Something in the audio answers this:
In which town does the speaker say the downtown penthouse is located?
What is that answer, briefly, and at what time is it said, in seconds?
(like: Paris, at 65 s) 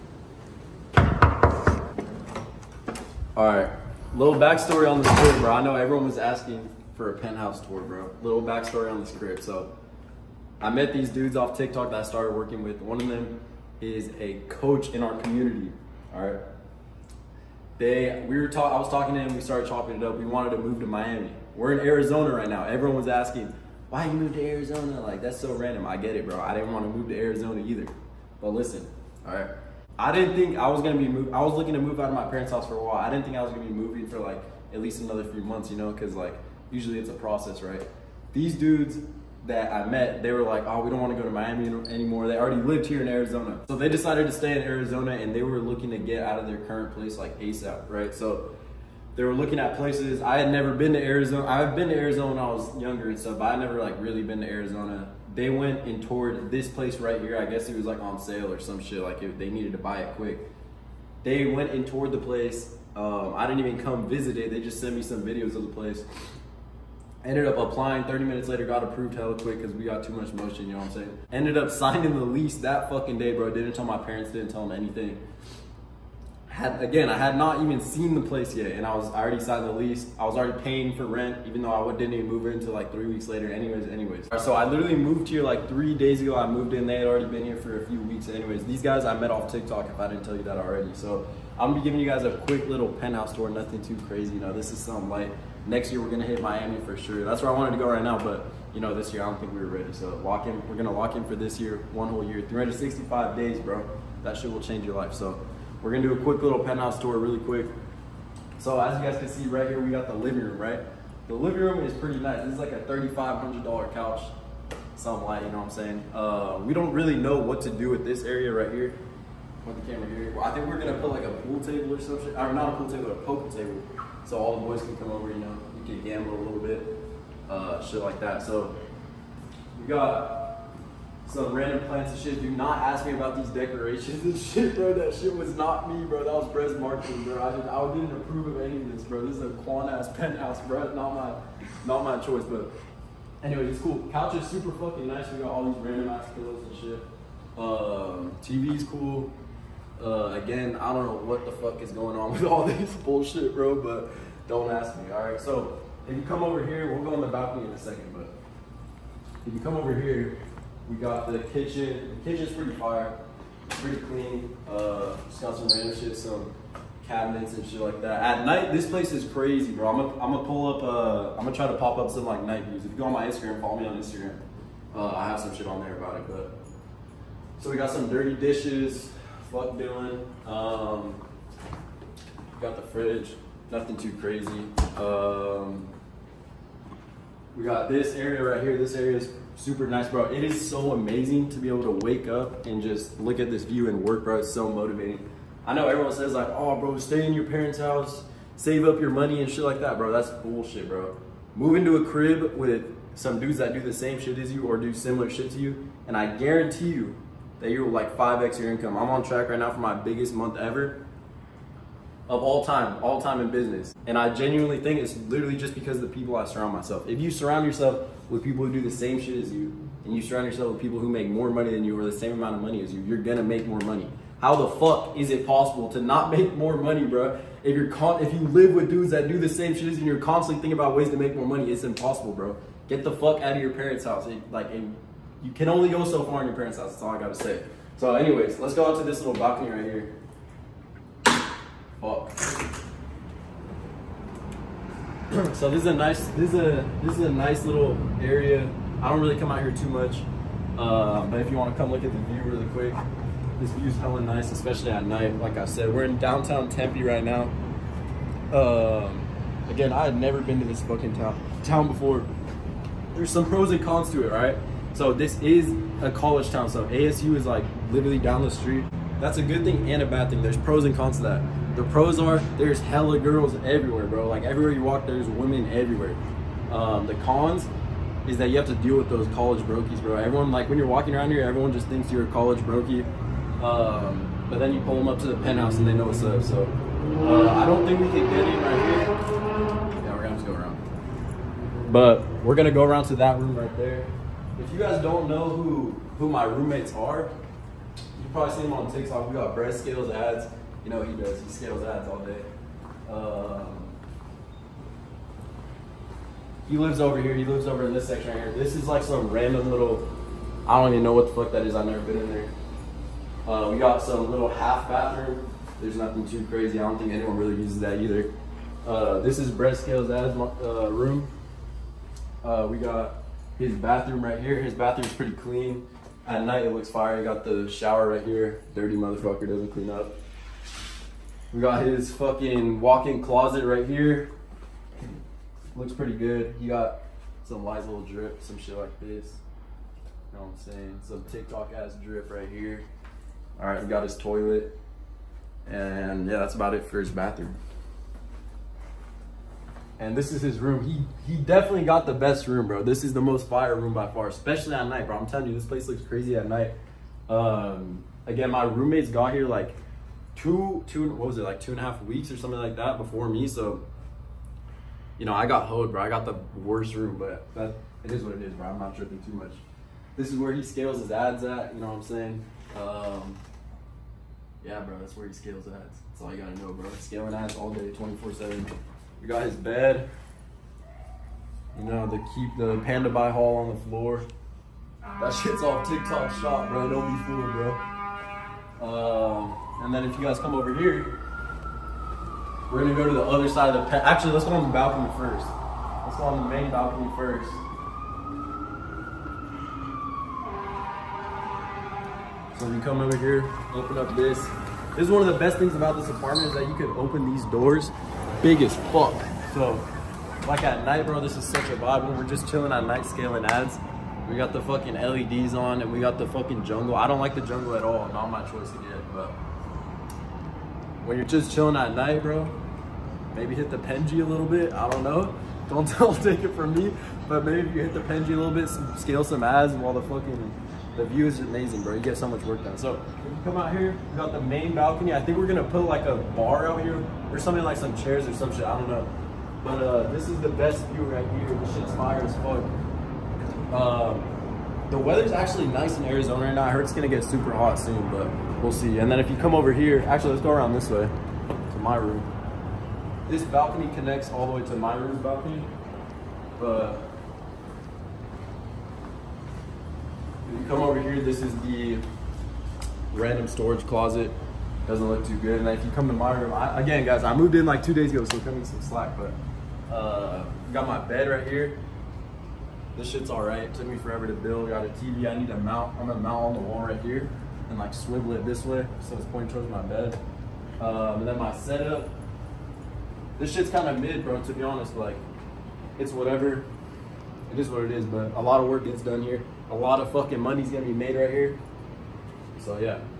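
Tempe, at 256 s.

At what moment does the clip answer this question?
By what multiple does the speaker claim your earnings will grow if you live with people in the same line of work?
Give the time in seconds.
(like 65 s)
208 s.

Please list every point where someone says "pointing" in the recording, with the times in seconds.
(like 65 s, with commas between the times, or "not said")
479 s.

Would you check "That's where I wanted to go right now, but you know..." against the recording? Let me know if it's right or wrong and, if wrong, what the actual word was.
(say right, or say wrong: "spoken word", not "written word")
right.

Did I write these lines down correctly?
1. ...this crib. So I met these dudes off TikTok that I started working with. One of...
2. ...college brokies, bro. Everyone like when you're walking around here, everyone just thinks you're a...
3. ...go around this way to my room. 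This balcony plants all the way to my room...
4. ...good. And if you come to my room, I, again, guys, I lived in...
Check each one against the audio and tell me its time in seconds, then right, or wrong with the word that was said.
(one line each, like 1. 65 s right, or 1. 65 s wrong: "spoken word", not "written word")
1. 9 s right
2. 279 s right
3. 450 s wrong: "connects", not "plants"
4. 465 s wrong: "moved", not "lived".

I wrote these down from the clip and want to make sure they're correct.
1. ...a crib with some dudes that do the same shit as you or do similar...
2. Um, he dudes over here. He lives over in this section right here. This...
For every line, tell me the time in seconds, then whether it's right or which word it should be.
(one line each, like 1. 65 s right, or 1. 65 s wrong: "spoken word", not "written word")
1. 201 s right
2. 303 s wrong: "lives", not "dudes".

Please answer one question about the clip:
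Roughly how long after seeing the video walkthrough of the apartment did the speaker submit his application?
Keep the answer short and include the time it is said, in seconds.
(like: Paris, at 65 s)
30 minutes, at 68 s.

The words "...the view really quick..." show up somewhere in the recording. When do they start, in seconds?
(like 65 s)
252 s.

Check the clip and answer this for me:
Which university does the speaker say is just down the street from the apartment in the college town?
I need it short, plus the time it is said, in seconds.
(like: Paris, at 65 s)
ASU, at 266 s.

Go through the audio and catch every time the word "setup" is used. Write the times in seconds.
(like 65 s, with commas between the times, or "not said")
481 s.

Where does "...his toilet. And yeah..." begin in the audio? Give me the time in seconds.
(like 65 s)
344 s.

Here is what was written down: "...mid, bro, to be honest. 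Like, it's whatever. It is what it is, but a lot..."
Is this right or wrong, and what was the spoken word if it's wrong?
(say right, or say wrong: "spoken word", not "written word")
right.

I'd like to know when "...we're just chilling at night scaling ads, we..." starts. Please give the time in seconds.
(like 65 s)
412 s.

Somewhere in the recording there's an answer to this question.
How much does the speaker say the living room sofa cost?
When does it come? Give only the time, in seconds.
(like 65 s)
112 s.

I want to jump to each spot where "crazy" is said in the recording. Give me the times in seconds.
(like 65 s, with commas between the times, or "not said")
94 s, 169 s, 184 s, 316 s, 356 s.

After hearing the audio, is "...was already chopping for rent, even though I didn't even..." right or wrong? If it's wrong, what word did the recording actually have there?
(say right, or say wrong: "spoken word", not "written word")
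wrong: "paying", not "chopping".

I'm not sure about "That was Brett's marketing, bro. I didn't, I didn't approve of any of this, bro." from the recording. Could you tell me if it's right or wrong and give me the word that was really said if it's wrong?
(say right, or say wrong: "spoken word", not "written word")
right.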